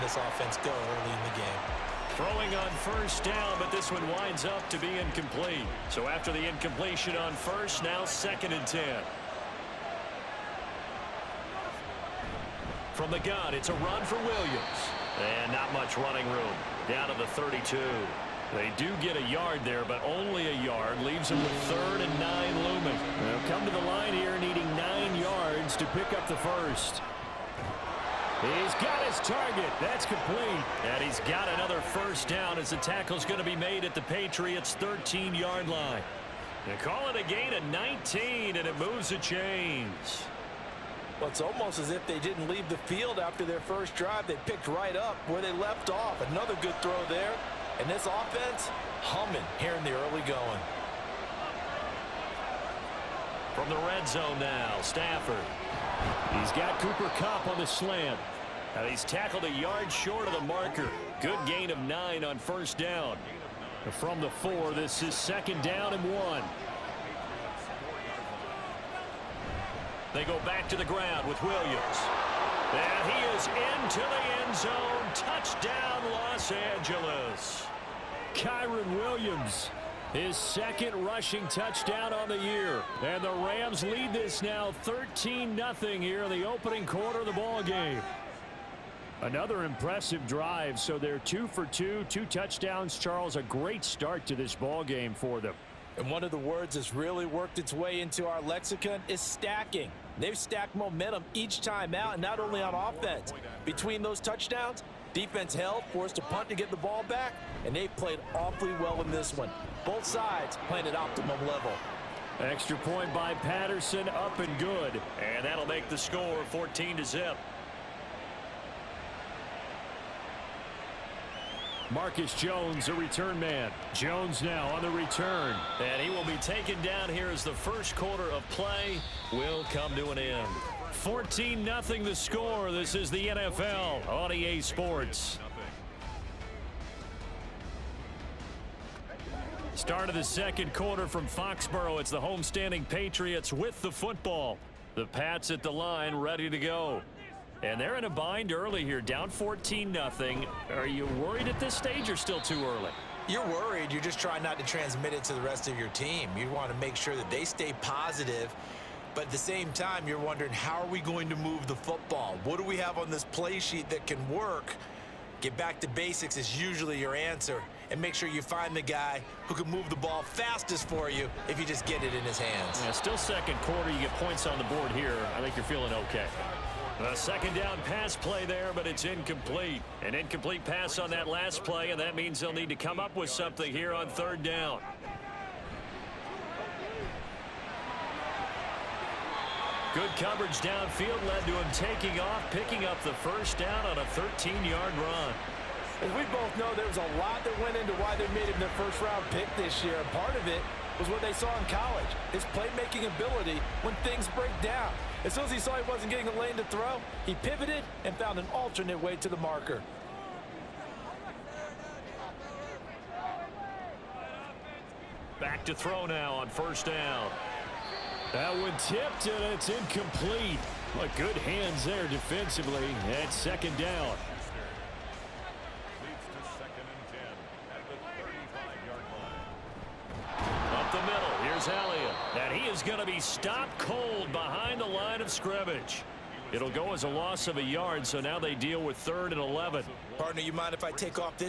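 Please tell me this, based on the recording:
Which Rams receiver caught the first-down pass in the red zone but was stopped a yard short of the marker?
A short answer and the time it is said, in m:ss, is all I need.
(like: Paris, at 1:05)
Cooper Kupp, at 0:56.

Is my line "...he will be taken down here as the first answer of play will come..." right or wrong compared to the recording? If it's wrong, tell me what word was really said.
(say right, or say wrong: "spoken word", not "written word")
wrong: "quarter", not "answer".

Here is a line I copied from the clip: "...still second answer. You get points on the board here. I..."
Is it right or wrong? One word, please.
wrong.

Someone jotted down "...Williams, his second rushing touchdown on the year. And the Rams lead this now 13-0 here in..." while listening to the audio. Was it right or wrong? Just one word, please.
right.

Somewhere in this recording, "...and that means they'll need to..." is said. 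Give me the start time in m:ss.
3:01.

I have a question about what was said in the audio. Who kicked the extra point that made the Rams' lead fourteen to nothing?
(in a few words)
Patterson.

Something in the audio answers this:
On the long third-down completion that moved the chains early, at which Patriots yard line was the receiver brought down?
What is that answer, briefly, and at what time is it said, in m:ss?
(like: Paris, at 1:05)
13, at 0:34.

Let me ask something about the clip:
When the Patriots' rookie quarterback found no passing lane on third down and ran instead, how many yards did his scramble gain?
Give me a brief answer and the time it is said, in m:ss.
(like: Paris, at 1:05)
13, at 3:14.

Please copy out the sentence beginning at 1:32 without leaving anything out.
Charles, a great start to this ball game for them.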